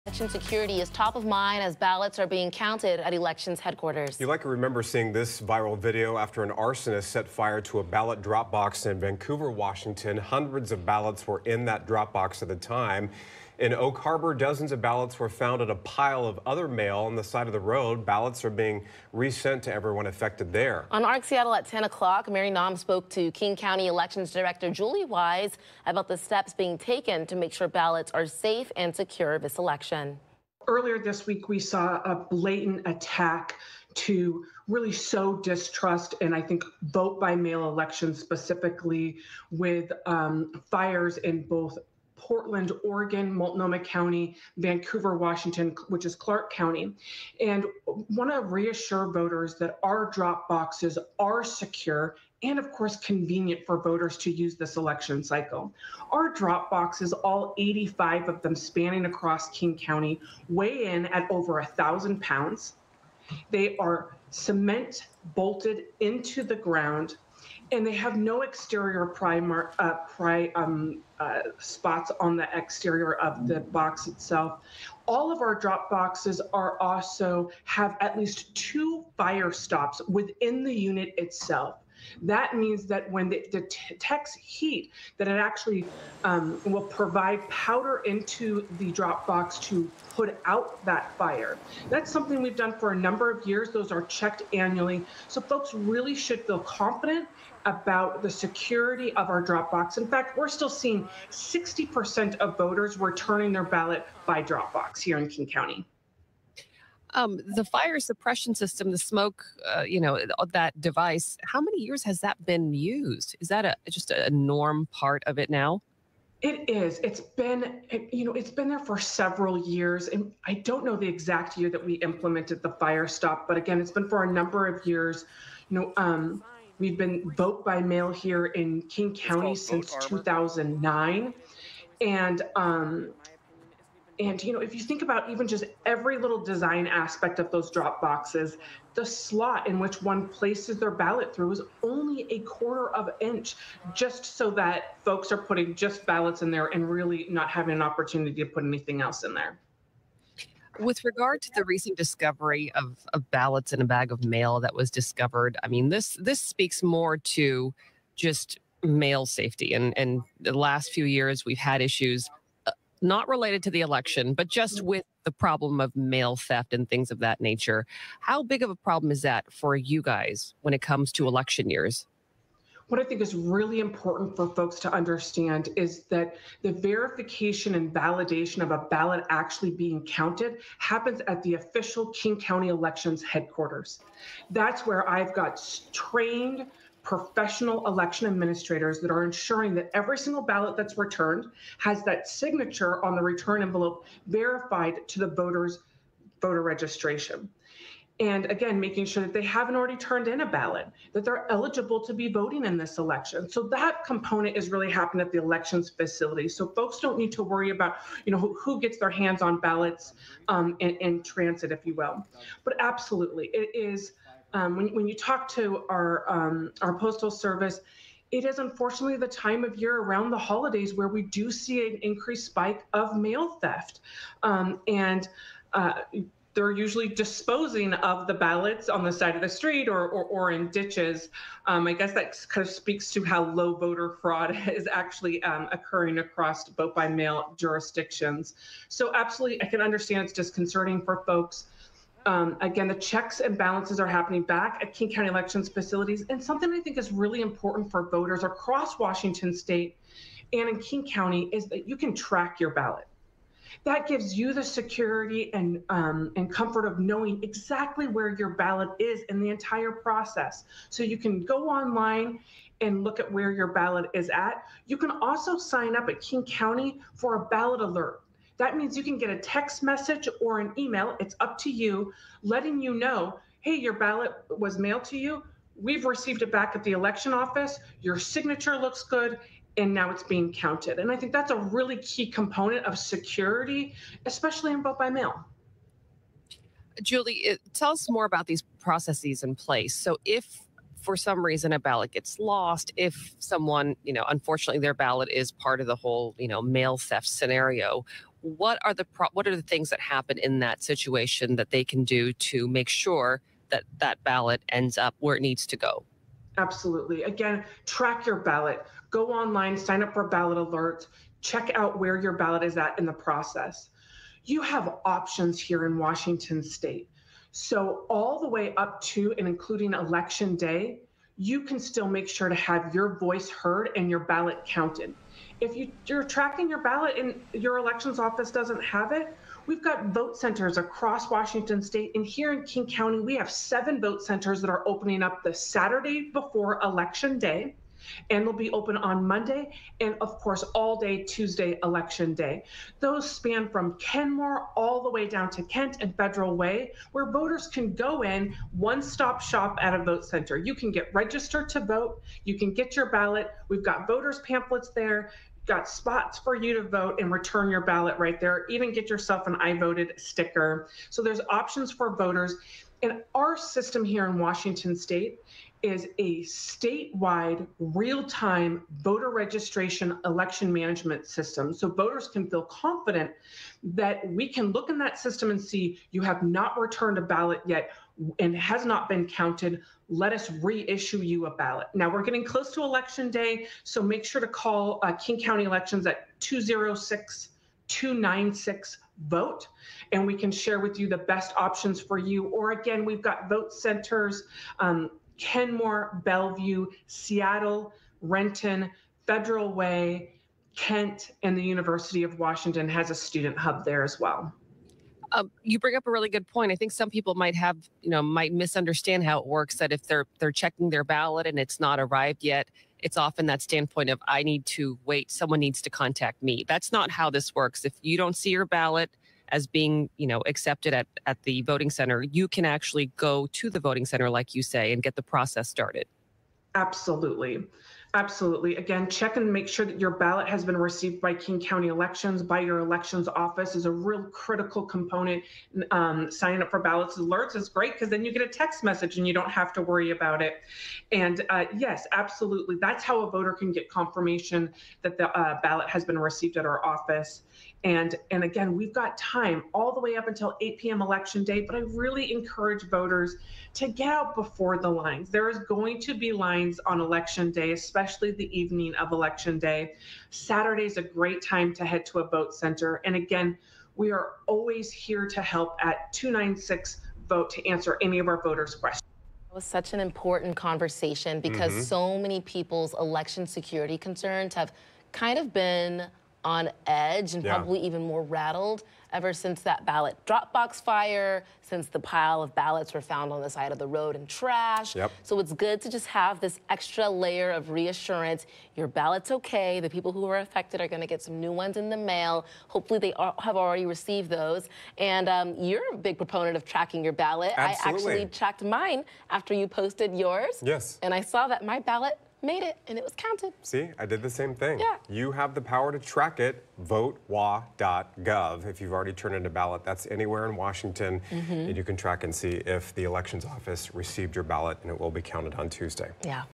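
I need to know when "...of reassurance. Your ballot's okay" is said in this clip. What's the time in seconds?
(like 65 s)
487 s.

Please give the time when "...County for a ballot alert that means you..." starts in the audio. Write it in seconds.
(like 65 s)
266 s.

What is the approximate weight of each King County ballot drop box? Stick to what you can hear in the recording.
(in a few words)
Over 1,000 pounds.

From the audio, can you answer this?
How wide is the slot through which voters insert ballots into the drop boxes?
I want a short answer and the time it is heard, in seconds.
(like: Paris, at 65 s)
A quarter of an inch, at 142 s.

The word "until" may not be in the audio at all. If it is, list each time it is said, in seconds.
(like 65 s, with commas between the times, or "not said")
450 s.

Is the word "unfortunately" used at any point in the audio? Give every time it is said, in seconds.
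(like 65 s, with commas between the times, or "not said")
218 s, 294 s.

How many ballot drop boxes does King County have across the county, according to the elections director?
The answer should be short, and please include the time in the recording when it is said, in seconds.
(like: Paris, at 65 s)
85, at 57 s.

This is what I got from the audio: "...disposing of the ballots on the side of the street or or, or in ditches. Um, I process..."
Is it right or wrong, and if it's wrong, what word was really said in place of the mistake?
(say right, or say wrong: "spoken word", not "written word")
wrong: "guess", not "process".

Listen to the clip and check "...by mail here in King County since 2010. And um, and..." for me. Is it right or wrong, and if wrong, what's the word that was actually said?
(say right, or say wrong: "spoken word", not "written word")
wrong: "2009", not "2010".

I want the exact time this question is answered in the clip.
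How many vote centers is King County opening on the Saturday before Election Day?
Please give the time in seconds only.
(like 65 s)
333 s.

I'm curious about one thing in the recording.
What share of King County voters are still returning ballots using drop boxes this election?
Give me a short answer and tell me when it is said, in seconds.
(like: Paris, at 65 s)
60%, at 101 s.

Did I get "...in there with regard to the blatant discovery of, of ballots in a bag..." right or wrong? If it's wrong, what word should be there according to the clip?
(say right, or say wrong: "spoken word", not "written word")
wrong: "recent", not "blatant".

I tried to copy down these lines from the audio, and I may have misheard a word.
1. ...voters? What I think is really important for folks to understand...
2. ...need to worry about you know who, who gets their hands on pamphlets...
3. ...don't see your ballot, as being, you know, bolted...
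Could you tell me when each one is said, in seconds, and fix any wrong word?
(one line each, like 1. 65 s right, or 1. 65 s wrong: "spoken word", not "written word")
1. 171 s wrong: "years", not "voters"
2. 207 s wrong: "ballots", not "pamphlets"
3. 418 s wrong: "accepted", not "bolted".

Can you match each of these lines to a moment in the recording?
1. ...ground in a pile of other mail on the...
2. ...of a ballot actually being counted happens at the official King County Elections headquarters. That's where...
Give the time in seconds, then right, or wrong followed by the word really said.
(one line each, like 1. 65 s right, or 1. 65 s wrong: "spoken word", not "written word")
1. 15 s wrong: "found", not "ground"
2. 178 s right.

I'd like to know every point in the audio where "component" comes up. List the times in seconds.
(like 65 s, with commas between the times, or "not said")
204 s, 282 s, 434 s.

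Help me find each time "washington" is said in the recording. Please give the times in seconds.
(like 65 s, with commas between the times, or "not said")
9 s, 45 s, 248 s, 315 s, 331 s, 364 s, 402 s, 510 s.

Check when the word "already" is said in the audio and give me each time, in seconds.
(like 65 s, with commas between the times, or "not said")
199 s, 493 s, 508 s.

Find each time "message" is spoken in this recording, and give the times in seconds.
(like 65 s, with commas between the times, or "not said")
269 s, 438 s.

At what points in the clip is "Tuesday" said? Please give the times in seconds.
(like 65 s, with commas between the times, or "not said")
341 s, 515 s.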